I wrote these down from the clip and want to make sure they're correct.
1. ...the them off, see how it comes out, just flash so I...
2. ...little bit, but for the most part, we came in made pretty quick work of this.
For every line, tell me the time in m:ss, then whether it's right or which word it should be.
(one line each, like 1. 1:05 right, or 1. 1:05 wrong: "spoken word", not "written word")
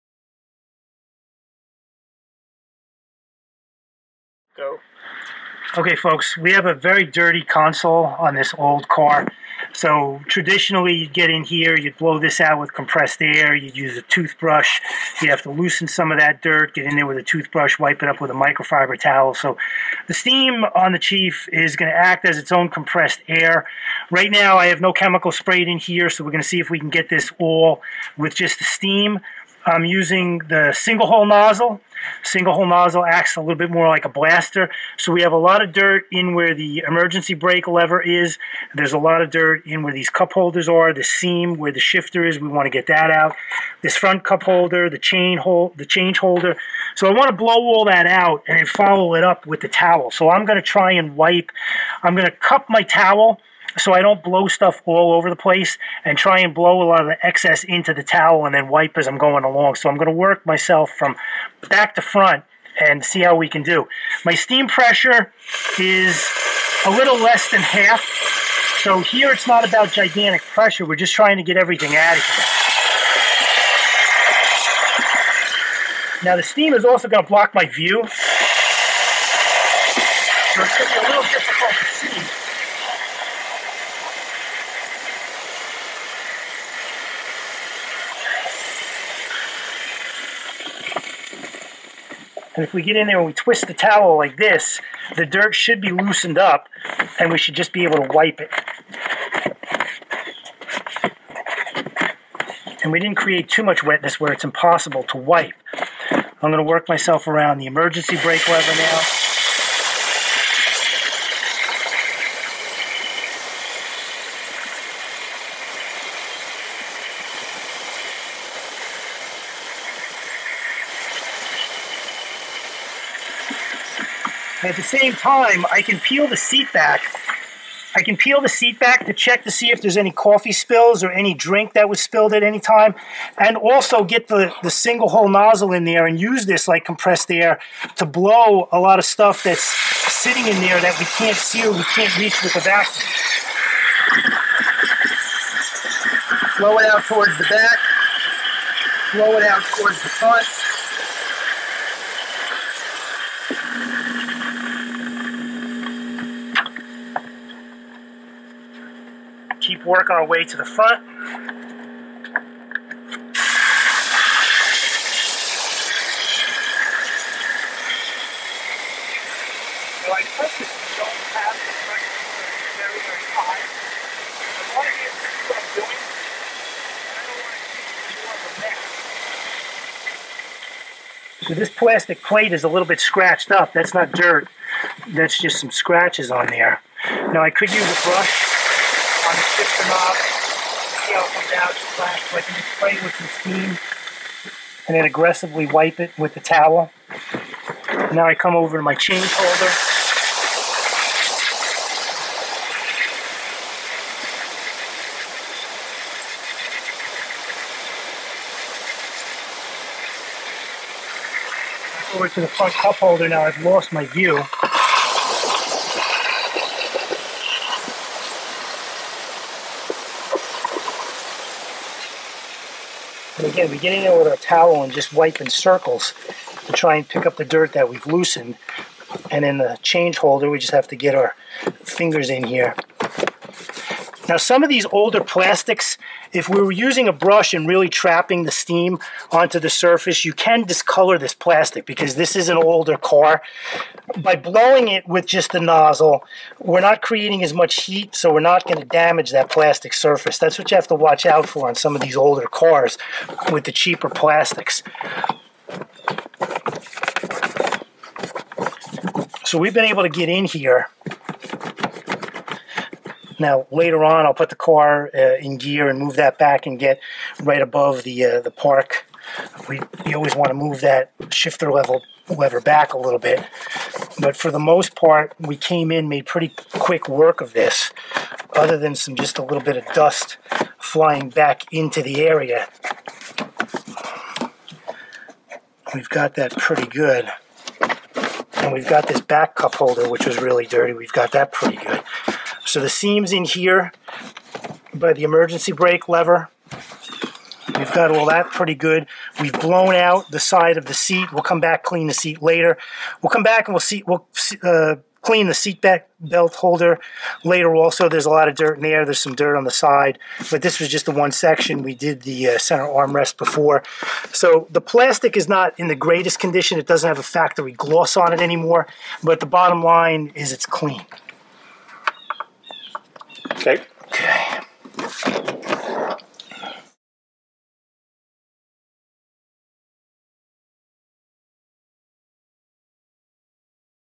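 1. 3:09 right
2. 4:32 right.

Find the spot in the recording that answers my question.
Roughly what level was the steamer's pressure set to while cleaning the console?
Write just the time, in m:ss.
1:06.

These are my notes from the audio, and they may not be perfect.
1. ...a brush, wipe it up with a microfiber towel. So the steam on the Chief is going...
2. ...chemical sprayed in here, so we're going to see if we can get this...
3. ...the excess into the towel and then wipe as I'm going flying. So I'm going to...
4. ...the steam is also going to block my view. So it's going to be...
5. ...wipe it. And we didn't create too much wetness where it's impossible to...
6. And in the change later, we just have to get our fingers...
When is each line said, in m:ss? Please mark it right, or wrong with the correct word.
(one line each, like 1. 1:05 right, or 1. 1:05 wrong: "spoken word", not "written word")
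1. 0:17 wrong: "toothbrush", not "brush"
2. 0:24 right
3. 0:57 wrong: "along", not "flying"
4. 1:16 right
5. 1:38 right
6. 3:49 wrong: "holder", not "later".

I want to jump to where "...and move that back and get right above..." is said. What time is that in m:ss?
4:25.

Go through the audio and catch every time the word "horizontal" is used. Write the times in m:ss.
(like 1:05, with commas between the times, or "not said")
not said.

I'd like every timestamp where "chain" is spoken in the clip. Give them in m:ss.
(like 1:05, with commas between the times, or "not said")
0:44, 3:18.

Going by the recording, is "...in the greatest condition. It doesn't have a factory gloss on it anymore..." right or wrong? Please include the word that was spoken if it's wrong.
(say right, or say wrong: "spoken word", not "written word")
right.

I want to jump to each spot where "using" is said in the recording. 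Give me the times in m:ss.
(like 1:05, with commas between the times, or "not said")
0:29, 3:56.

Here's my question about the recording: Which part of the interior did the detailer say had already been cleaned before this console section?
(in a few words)
center armrest.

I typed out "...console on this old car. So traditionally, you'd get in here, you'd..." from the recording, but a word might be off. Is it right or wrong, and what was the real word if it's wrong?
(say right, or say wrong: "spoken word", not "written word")
right.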